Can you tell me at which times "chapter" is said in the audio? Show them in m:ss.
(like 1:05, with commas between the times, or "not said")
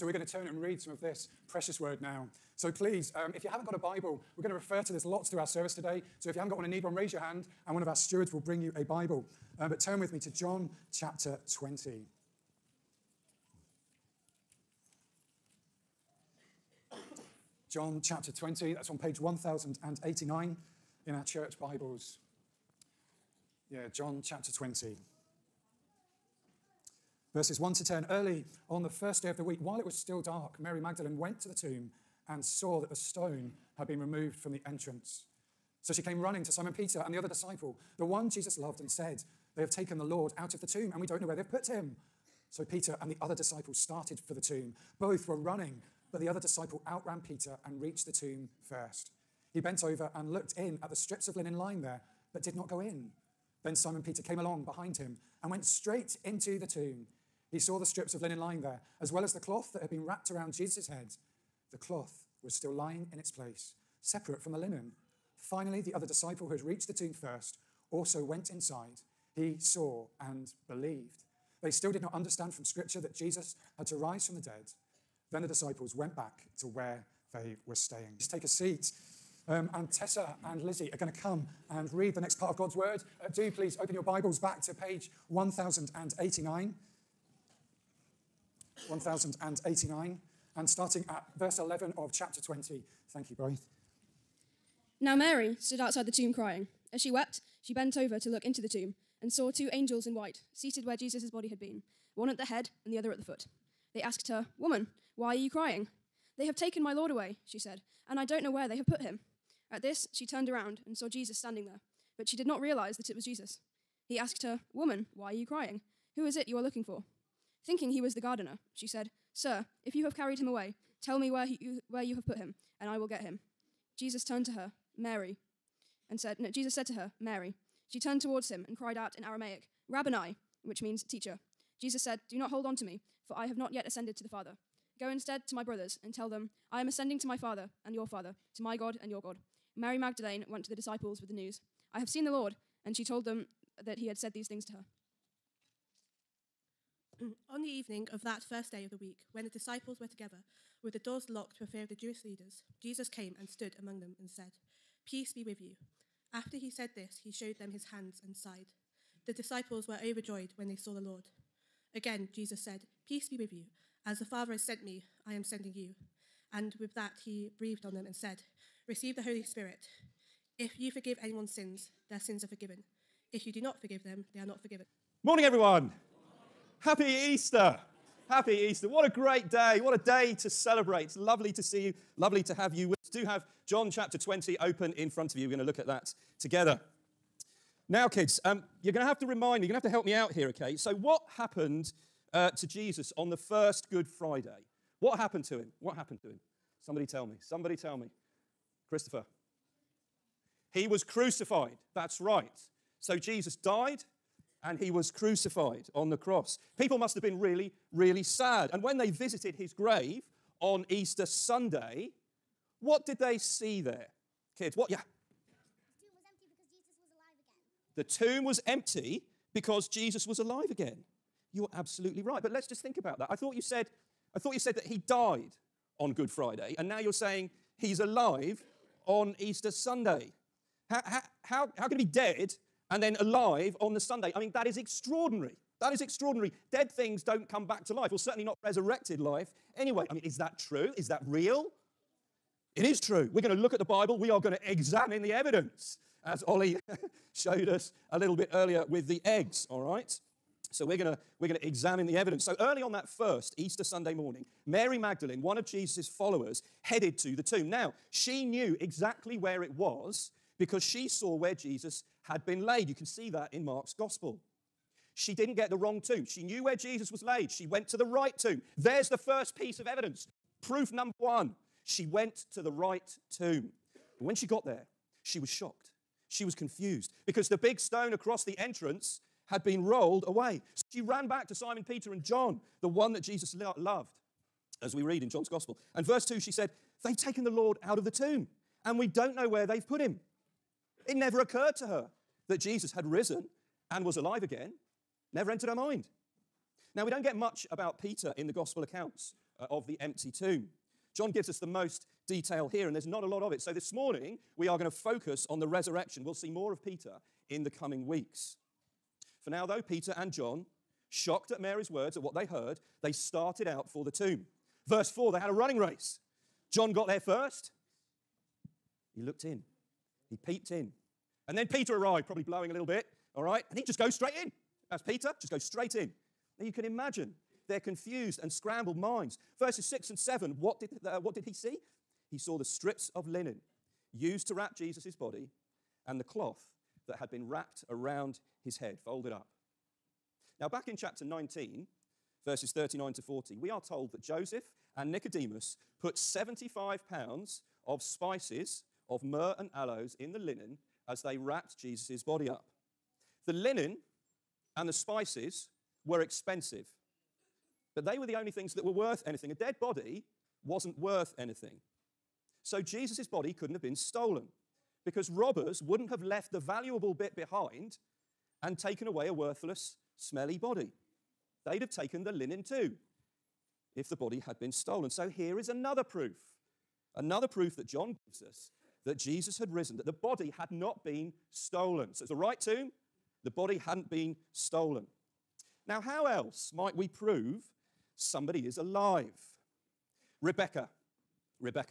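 0:10, 0:18, 0:24, 1:32, 3:03, 5:40.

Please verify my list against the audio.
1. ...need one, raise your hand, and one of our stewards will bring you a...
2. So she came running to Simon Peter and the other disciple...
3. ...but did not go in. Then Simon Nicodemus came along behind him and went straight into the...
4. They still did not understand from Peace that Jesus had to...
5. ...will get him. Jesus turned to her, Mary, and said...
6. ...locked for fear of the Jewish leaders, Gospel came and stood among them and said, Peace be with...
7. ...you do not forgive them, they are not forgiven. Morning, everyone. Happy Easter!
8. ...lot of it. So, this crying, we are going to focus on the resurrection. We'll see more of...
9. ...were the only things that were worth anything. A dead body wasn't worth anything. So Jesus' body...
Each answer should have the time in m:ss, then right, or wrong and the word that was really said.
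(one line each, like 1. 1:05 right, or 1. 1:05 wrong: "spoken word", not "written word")
1. 0:06 right
2. 0:35 right
3. 0:52 wrong: "Peter", not "Nicodemus"
4. 1:11 wrong: "Scripture", not "Peace"
5. 2:02 right
6. 2:31 wrong: "Jesus", not "Gospel"
7. 2:53 right
8. 5:03 wrong: "morning", not "crying"
9. 5:58 right.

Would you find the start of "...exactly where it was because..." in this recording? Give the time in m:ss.
4:18.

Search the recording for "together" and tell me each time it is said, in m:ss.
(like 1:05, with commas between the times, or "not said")
2:30, 3:06.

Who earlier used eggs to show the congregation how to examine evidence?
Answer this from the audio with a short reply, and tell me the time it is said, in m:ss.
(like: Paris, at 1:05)
Ollie, at 4:06.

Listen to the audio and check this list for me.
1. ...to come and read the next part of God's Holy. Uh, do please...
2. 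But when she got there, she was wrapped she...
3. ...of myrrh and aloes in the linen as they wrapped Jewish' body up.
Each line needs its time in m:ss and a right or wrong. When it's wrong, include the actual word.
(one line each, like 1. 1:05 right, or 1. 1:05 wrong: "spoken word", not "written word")
1. 1:21 wrong: "Word", not "Holy"
2. 4:34 wrong: "shocked", not "wrapped"
3. 5:49 wrong: "Jesus", not "Jewish".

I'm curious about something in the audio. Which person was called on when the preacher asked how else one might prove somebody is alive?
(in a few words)
Rebecca.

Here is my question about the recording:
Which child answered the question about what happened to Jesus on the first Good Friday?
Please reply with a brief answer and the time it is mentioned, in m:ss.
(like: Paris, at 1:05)
Christopher, at 3:18.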